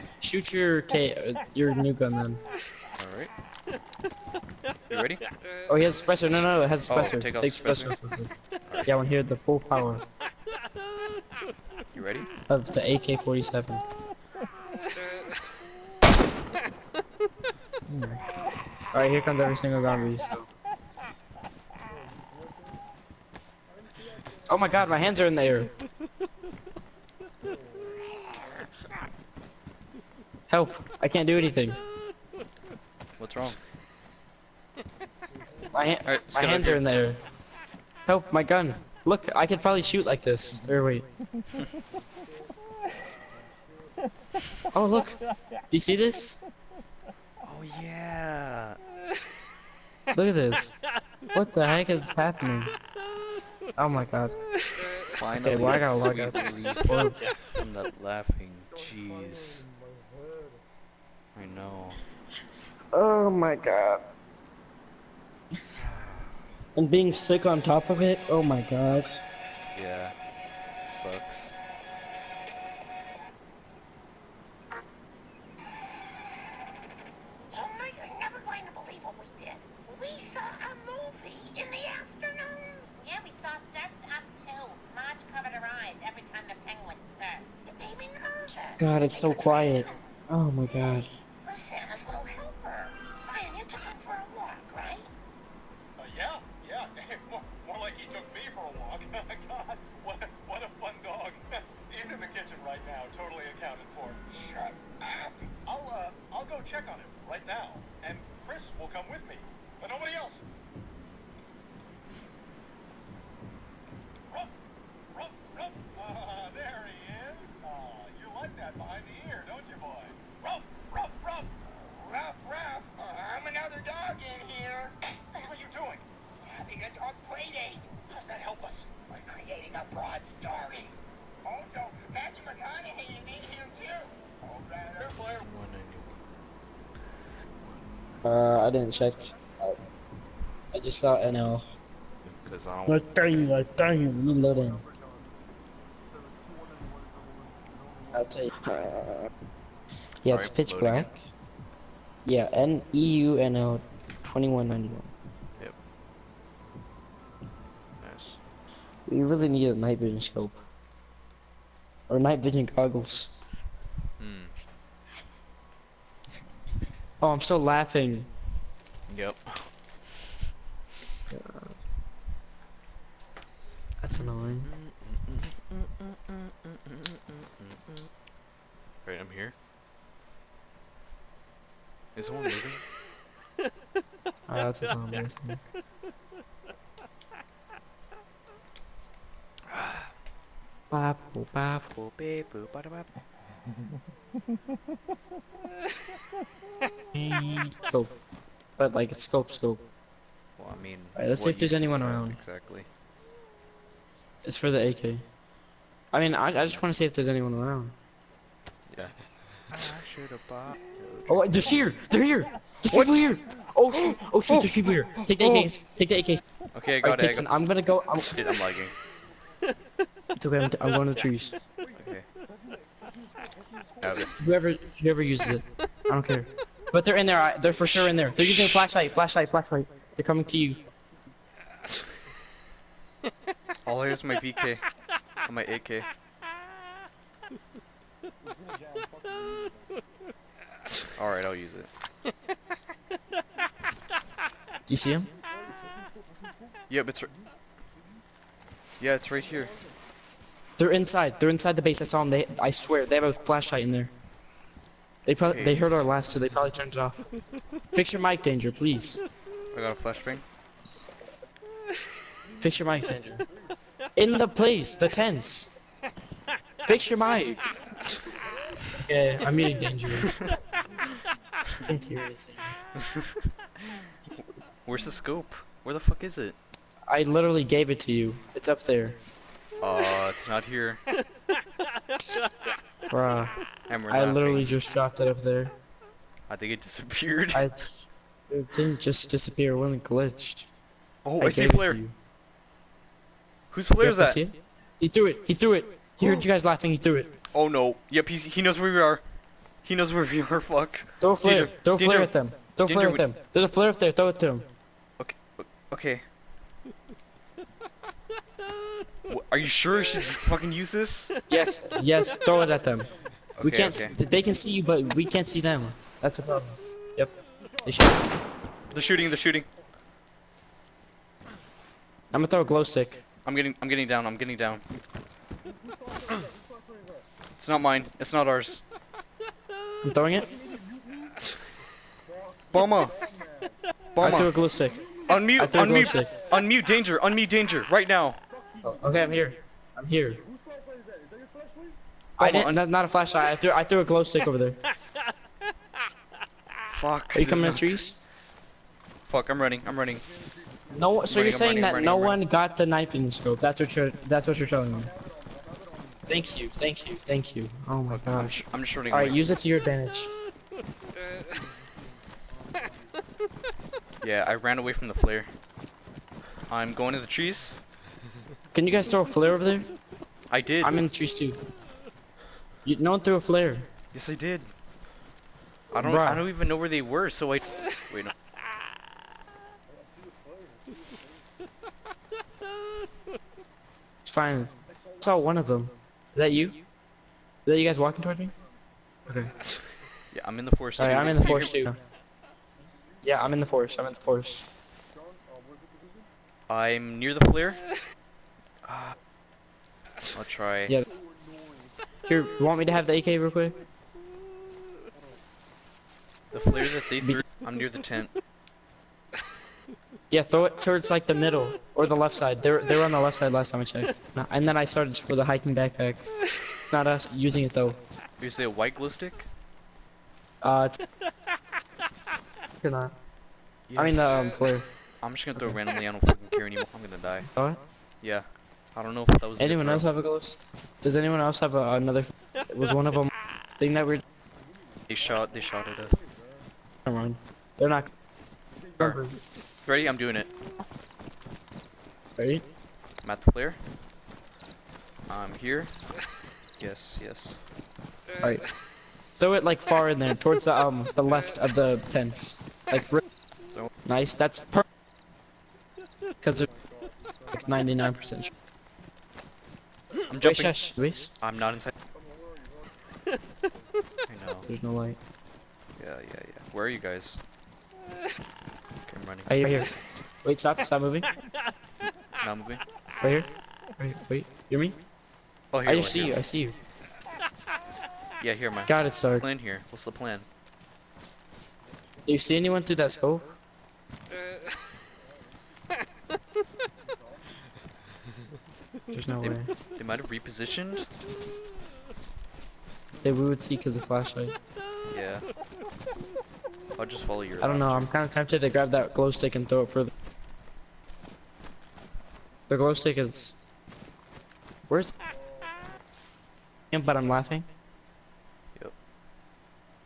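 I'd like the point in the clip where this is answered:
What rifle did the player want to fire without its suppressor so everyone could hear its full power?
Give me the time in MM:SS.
00:12.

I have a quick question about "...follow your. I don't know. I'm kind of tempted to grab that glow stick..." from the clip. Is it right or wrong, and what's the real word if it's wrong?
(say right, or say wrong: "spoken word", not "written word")
right.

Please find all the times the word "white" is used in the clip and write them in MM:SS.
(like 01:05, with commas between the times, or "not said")
06:58.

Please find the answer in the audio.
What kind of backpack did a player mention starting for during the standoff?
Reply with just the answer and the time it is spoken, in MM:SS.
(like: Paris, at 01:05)
hiking backpack, at 06:55.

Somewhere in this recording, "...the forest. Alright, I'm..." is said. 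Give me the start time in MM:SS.
06:30.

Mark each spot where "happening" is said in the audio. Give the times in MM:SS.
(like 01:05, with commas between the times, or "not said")
00:52.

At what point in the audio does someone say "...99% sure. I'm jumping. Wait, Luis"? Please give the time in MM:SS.
07:37.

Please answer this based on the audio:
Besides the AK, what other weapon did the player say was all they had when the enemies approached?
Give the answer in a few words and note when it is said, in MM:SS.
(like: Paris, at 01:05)
BK, at 03:54.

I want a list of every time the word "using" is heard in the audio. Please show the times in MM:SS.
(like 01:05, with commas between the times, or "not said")
03:48, 06:57.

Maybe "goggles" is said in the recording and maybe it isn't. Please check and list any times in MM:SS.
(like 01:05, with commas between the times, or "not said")
02:42.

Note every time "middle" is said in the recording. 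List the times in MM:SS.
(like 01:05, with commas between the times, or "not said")
06:51.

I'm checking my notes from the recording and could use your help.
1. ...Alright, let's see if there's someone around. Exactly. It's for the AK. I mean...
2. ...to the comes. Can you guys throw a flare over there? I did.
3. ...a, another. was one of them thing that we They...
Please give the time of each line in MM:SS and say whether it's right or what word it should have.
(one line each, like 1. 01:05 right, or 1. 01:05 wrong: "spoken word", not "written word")
1. 03:21 wrong: "anyone", not "someone"
2. 06:07 wrong: "trees", not "comes"
3. 07:11 right.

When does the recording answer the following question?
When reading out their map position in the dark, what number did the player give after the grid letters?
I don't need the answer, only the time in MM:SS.
02:34.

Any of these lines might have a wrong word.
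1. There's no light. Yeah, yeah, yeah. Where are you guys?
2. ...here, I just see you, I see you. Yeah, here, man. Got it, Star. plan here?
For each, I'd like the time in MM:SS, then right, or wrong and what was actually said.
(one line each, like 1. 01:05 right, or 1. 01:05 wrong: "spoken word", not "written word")
1. 07:44 right
2. 07:55 right.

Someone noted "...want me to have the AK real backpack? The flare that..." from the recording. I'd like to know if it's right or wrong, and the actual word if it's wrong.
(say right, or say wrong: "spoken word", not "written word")
wrong: "quick", not "backpack".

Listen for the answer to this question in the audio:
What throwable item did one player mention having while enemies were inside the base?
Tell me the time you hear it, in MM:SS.
04:20.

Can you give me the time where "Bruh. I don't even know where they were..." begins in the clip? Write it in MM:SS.
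06:16.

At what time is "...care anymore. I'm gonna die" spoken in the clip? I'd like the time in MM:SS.
07:06.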